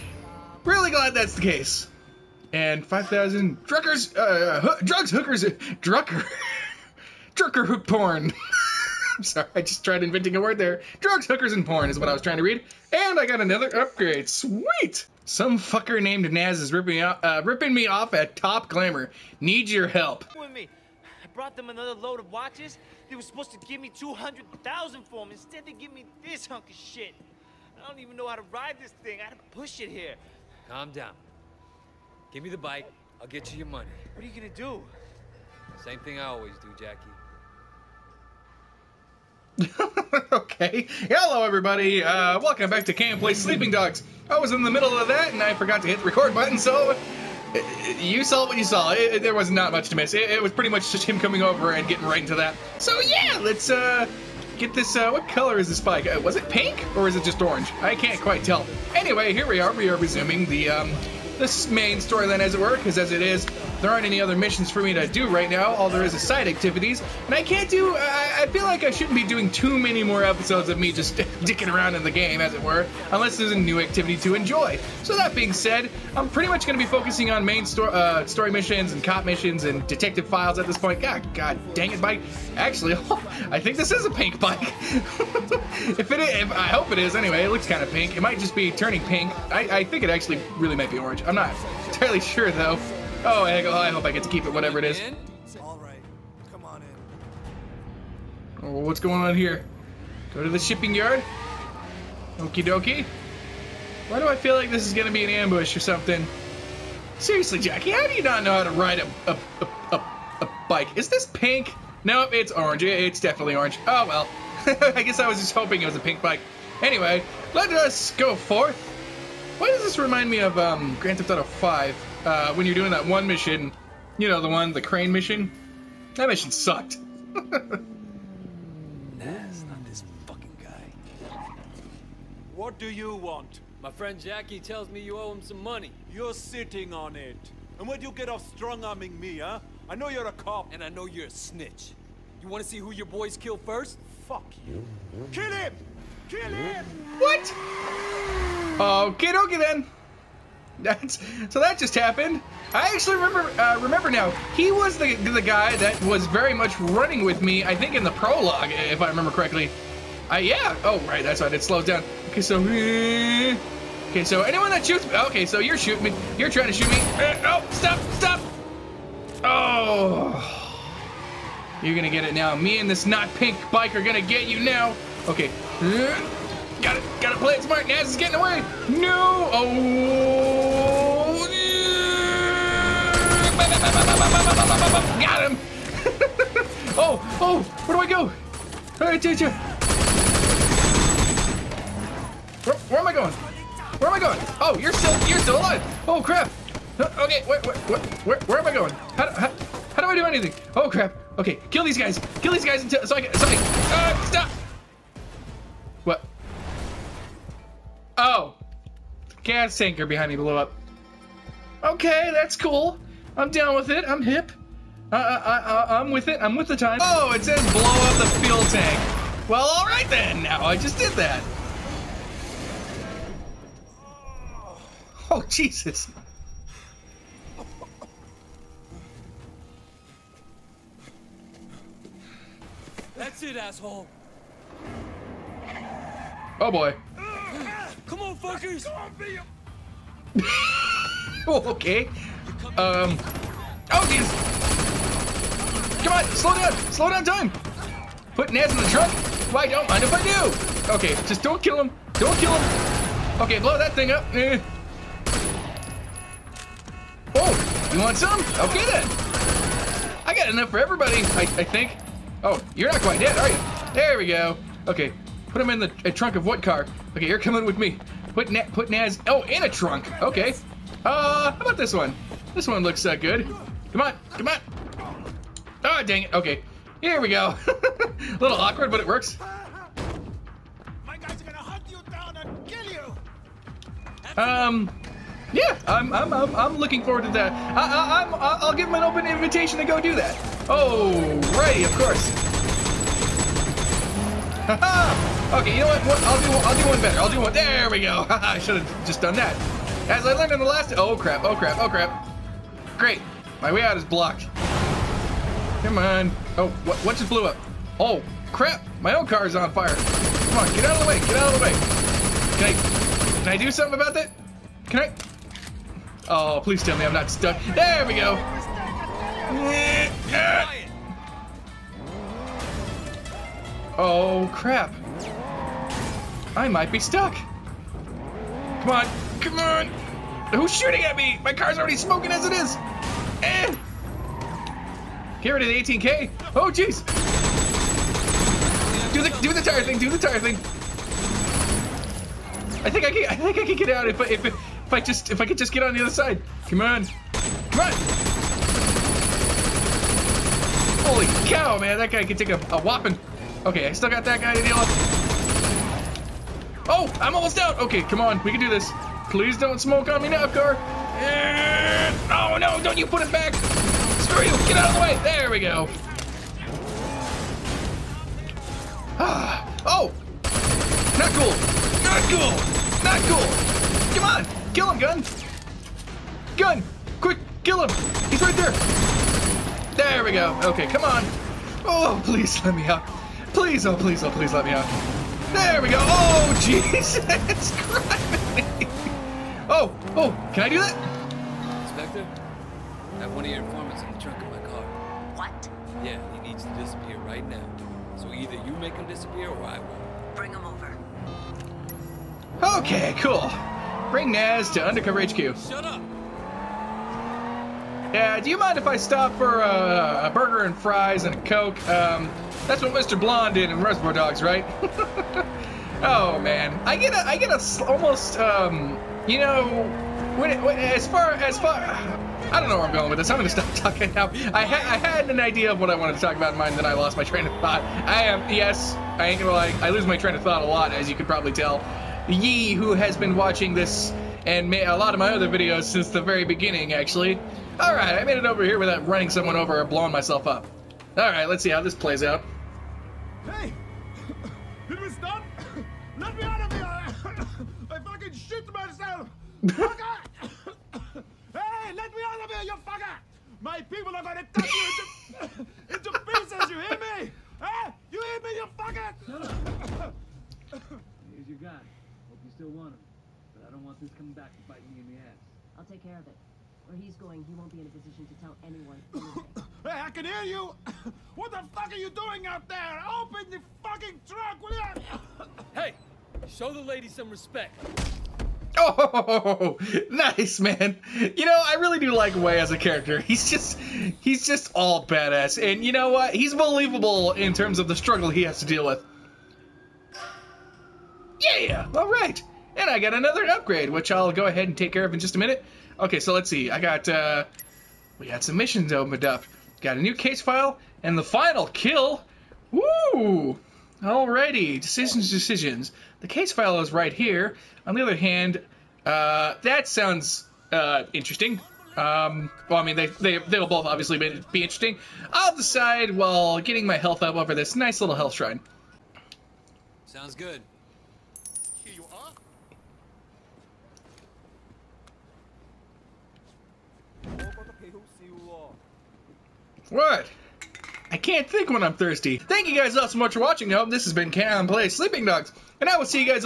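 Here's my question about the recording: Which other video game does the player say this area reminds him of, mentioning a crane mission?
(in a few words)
Grand Theft Auto 5.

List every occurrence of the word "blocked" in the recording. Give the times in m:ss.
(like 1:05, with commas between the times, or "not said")
5:04.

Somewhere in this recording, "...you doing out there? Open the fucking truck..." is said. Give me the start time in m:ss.
7:51.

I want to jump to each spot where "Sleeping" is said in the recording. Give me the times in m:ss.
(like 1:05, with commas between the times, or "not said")
0:43, 8:54.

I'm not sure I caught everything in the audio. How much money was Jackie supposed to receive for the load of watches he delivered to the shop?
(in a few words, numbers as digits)
200,000.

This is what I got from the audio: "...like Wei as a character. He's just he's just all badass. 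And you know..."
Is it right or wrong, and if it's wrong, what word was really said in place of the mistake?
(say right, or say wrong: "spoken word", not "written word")
right.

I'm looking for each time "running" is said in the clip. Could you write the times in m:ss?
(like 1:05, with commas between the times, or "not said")
2:36, 7:19.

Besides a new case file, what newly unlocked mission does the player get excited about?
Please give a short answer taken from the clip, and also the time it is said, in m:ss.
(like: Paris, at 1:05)
The Final Kill, at 8:21.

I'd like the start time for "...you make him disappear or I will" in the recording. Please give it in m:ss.
6:38.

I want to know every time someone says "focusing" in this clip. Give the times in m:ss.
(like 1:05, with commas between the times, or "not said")
1:16.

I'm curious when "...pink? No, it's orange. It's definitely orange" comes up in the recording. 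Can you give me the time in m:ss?
1:51.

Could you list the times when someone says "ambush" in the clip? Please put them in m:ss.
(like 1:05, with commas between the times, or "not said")
1:45.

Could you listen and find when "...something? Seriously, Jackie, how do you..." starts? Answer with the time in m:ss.
1:45.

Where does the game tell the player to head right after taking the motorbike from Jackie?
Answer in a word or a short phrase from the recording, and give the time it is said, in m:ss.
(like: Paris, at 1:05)
The shipping yard, at 1:40.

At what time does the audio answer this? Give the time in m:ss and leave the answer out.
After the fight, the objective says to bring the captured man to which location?
6:44.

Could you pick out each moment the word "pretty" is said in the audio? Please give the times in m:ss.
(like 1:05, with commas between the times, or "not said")
0:50, 1:16.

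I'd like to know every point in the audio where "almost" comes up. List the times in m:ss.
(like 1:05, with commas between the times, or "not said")
5:57, 6:57.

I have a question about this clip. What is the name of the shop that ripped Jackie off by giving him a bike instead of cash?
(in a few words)
Top Glamour.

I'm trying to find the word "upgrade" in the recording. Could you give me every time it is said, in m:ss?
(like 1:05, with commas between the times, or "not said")
0:13, 8:13.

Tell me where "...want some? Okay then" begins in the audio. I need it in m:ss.
4:17.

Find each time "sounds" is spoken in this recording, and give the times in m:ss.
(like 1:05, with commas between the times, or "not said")
8:29, 8:40.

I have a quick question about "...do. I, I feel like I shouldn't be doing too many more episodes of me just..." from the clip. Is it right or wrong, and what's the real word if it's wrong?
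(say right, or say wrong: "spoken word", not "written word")
right.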